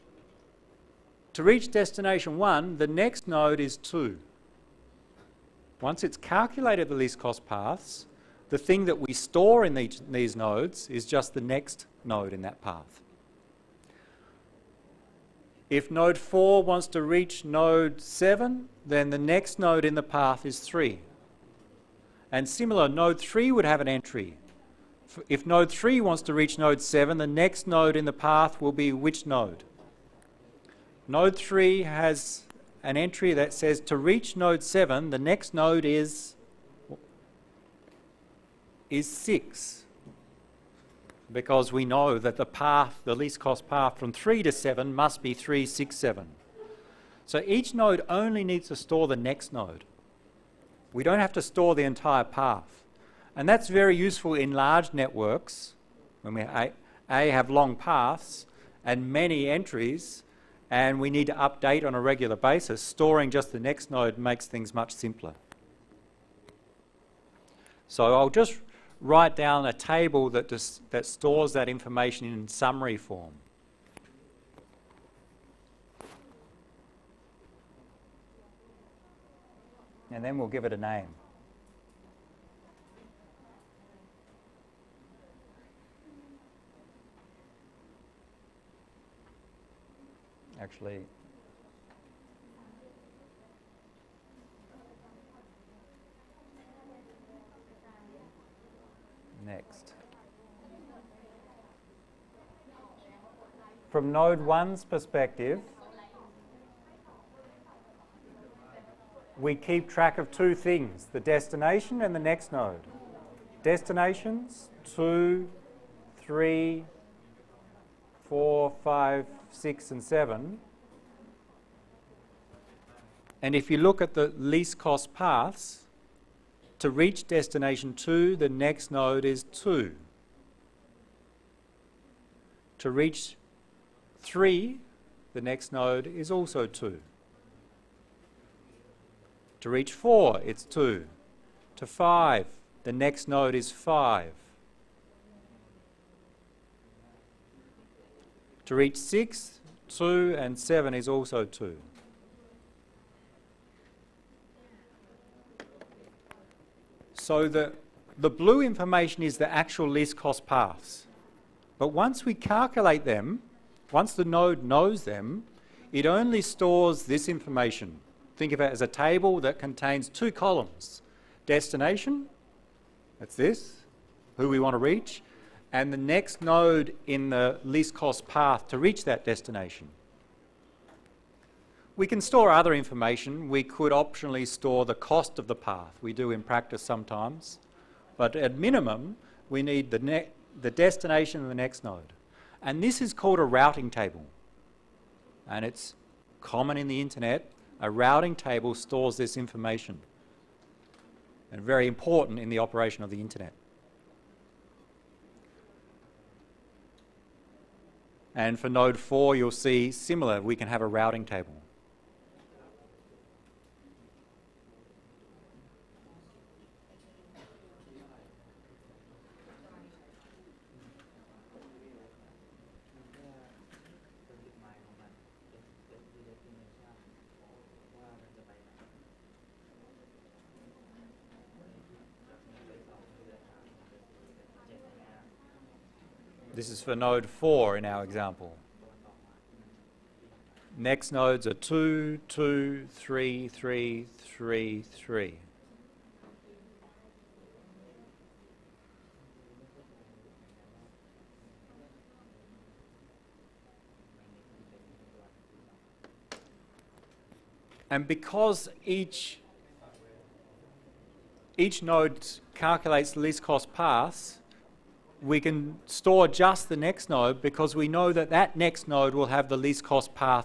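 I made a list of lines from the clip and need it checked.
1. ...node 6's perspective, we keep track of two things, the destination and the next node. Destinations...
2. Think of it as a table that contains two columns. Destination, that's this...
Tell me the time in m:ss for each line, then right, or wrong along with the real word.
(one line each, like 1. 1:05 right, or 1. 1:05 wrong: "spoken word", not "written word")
1. 1:44 wrong: "1", not "6"
2. 2:48 right.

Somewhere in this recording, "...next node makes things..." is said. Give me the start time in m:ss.
1:03.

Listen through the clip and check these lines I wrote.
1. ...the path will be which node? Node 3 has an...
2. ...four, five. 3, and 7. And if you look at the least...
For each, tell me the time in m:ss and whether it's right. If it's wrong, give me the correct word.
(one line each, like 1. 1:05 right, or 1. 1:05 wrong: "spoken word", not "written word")
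1. 0:28 right
2. 1:58 wrong: "6", not "3".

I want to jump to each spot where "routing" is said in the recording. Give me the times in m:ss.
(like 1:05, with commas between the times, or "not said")
3:13, 3:17, 3:30.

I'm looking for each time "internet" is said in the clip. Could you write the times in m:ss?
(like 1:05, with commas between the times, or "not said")
3:16, 3:23.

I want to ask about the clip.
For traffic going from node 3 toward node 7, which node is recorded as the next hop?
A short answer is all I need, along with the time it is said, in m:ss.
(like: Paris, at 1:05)
6, at 0:38.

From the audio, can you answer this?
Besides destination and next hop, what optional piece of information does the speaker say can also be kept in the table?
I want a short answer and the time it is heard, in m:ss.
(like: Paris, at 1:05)
The cost of the path, at 3:04.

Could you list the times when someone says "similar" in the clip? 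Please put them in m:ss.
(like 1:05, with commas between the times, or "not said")
0:22, 3:29.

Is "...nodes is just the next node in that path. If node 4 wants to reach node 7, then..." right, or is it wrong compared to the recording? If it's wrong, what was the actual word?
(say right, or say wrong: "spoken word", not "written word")
right.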